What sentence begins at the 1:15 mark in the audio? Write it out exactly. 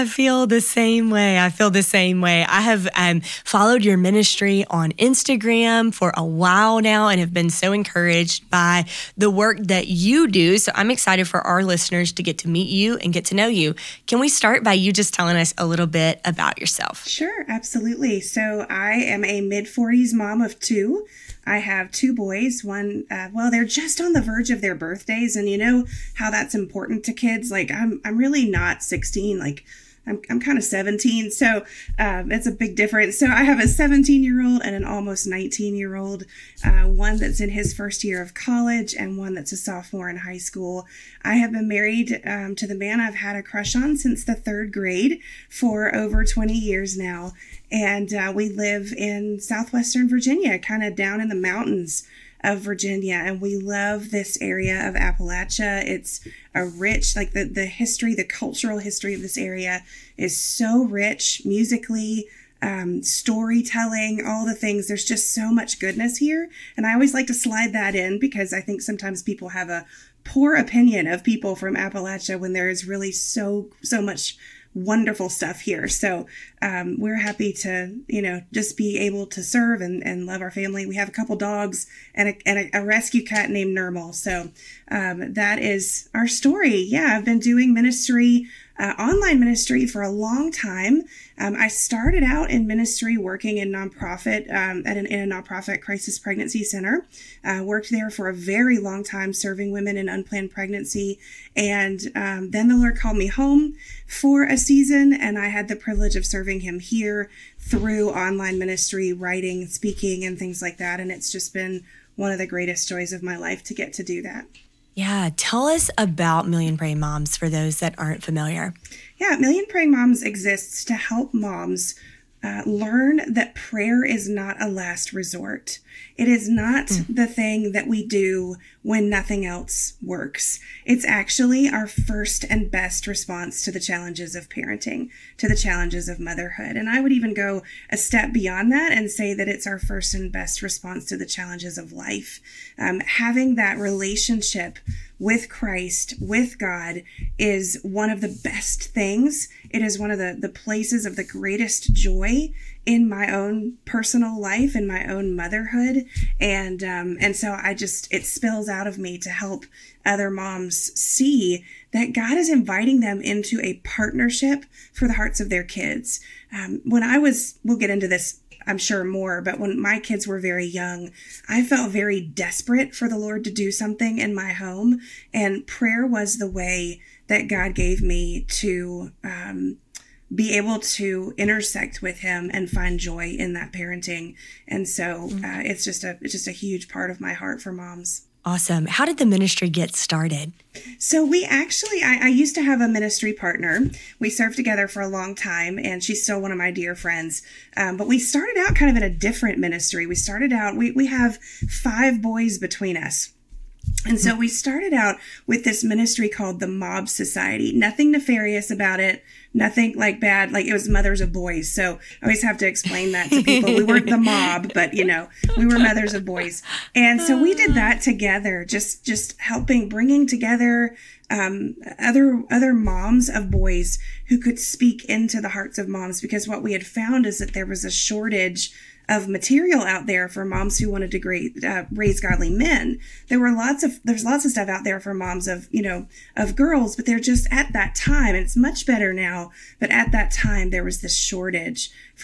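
So um, we're happy to, you know, just be able to serve and, and love our family.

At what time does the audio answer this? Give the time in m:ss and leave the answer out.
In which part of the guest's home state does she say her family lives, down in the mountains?
0:49.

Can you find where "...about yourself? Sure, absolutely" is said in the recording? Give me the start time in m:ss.
0:16.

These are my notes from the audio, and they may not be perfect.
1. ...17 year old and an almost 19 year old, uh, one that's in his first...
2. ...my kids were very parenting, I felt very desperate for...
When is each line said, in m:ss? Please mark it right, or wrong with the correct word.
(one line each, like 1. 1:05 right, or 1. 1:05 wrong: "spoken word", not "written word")
1. 0:33 right
2. 2:49 wrong: "young", not "parenting".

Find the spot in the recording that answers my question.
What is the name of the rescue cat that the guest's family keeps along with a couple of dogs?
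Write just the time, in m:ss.
1:23.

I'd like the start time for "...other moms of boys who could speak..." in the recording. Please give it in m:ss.
3:42.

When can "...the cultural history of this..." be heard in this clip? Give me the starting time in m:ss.
0:58.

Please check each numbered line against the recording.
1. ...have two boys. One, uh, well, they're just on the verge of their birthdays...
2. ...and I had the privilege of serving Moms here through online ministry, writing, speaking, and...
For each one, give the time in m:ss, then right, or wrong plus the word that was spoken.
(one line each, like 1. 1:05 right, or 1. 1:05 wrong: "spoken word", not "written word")
1. 0:21 right
2. 1:45 wrong: "Him", not "Moms".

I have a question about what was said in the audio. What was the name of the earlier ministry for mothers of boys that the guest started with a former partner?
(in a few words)
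The Mob Society.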